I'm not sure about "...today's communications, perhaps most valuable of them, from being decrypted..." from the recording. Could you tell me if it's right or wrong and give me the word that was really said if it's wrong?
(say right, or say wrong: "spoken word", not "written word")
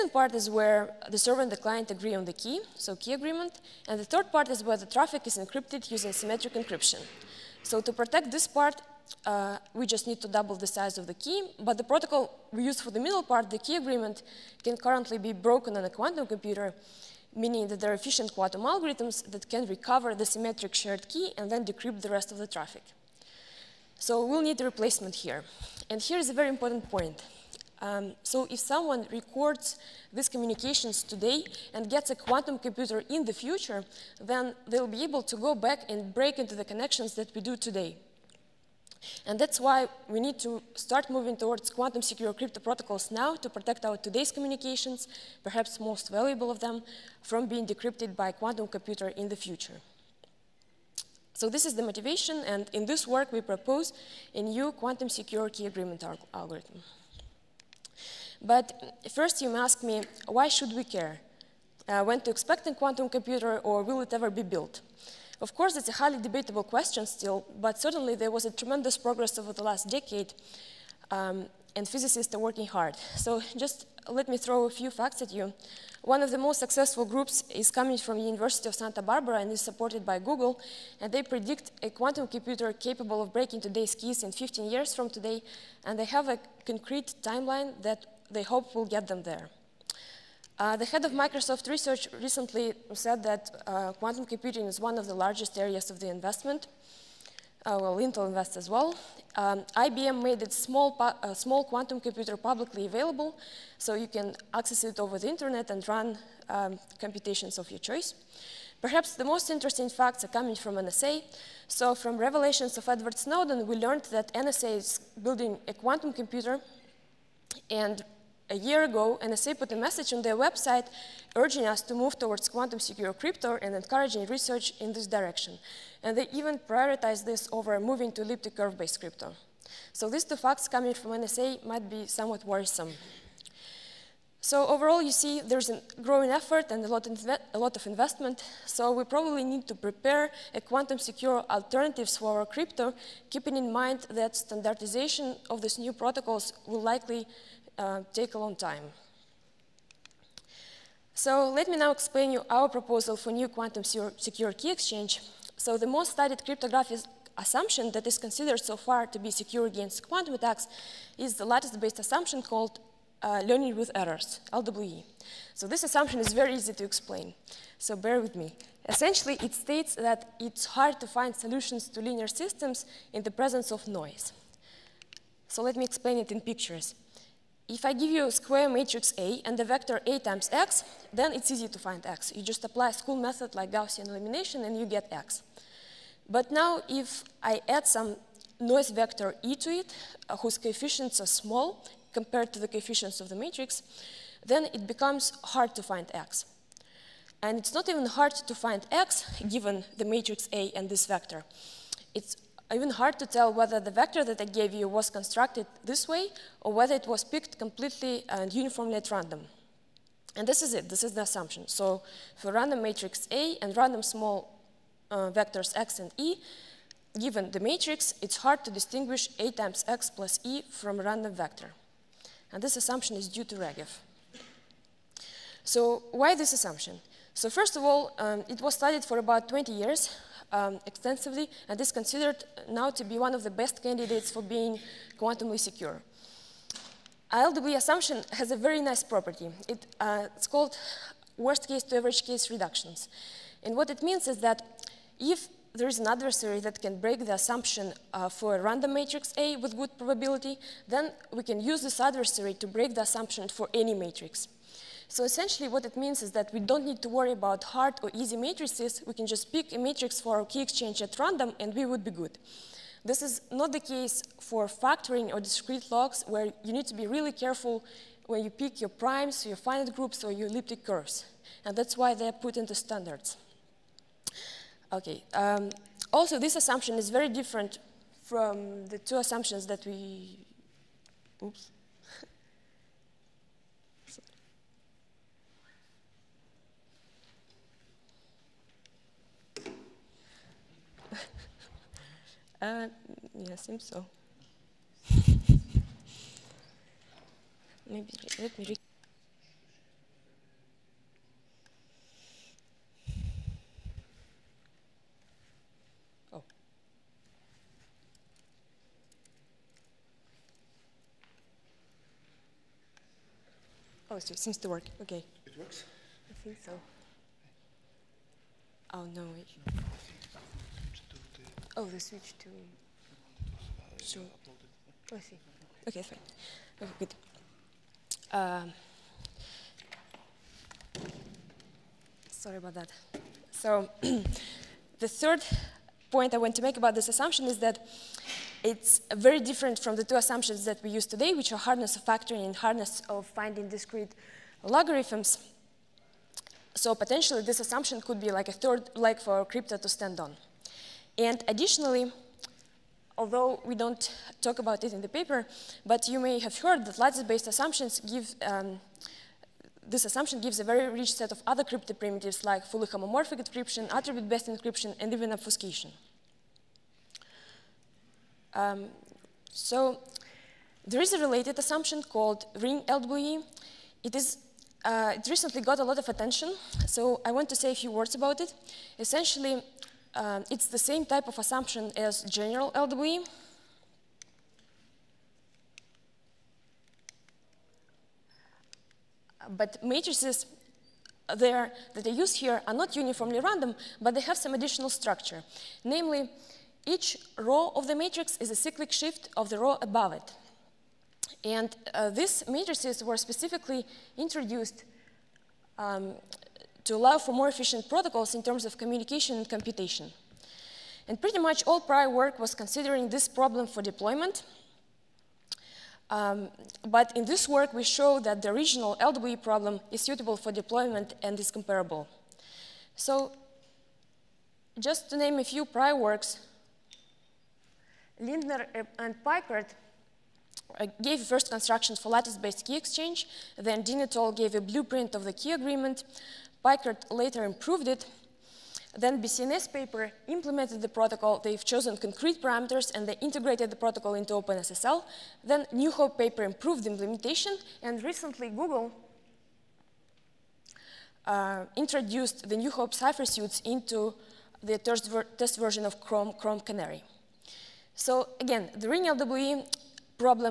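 right.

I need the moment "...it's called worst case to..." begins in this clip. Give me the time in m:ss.
4:00.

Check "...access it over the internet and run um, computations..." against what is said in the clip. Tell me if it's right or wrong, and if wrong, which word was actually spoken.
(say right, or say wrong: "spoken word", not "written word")
right.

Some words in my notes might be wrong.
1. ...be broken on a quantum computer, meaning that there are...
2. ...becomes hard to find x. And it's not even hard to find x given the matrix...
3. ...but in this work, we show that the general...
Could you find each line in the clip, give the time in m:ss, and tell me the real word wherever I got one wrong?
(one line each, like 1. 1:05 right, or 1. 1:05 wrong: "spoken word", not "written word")
1. 0:15 right
2. 3:14 right
3. 6:56 wrong: "original", not "general".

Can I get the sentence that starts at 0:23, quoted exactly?
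So we'll need a replacement here.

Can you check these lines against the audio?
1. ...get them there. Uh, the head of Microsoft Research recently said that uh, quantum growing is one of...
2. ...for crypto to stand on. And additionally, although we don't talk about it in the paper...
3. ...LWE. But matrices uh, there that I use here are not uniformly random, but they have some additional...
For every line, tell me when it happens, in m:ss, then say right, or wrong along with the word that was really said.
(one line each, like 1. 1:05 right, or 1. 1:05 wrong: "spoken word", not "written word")
1. 1:28 wrong: "computing", not "growing"
2. 5:49 right
3. 6:22 right.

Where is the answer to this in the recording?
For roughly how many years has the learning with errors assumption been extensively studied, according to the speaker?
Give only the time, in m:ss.
3:49.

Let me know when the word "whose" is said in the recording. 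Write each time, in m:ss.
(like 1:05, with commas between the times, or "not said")
3:10.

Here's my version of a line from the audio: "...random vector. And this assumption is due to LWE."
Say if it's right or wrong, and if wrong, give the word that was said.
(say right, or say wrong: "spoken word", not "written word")
wrong: "Regev", not "LWE".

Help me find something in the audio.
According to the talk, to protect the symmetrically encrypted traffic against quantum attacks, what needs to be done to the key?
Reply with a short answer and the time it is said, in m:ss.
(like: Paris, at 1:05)
double the size, at 0:10.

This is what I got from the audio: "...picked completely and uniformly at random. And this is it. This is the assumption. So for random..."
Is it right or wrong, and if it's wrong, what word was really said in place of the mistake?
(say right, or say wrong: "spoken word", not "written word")
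right.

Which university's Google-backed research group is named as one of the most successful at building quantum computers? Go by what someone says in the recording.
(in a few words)
University of Santa Barbara.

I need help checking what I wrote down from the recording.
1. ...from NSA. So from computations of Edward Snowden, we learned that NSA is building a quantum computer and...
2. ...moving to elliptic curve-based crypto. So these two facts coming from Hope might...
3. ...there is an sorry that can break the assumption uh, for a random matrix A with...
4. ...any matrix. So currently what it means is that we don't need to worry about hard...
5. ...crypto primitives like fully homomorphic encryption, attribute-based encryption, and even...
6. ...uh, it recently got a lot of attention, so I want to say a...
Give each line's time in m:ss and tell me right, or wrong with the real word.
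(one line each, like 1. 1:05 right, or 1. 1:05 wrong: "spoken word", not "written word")
1. 1:50 wrong: "revelations", not "computations"
2. 2:07 wrong: "NSA", not "Hope"
3. 4:05 wrong: "adversary", not "sorry"
4. 4:13 wrong: "essentially", not "currently"
5. 6:01 right
6. 6:14 right.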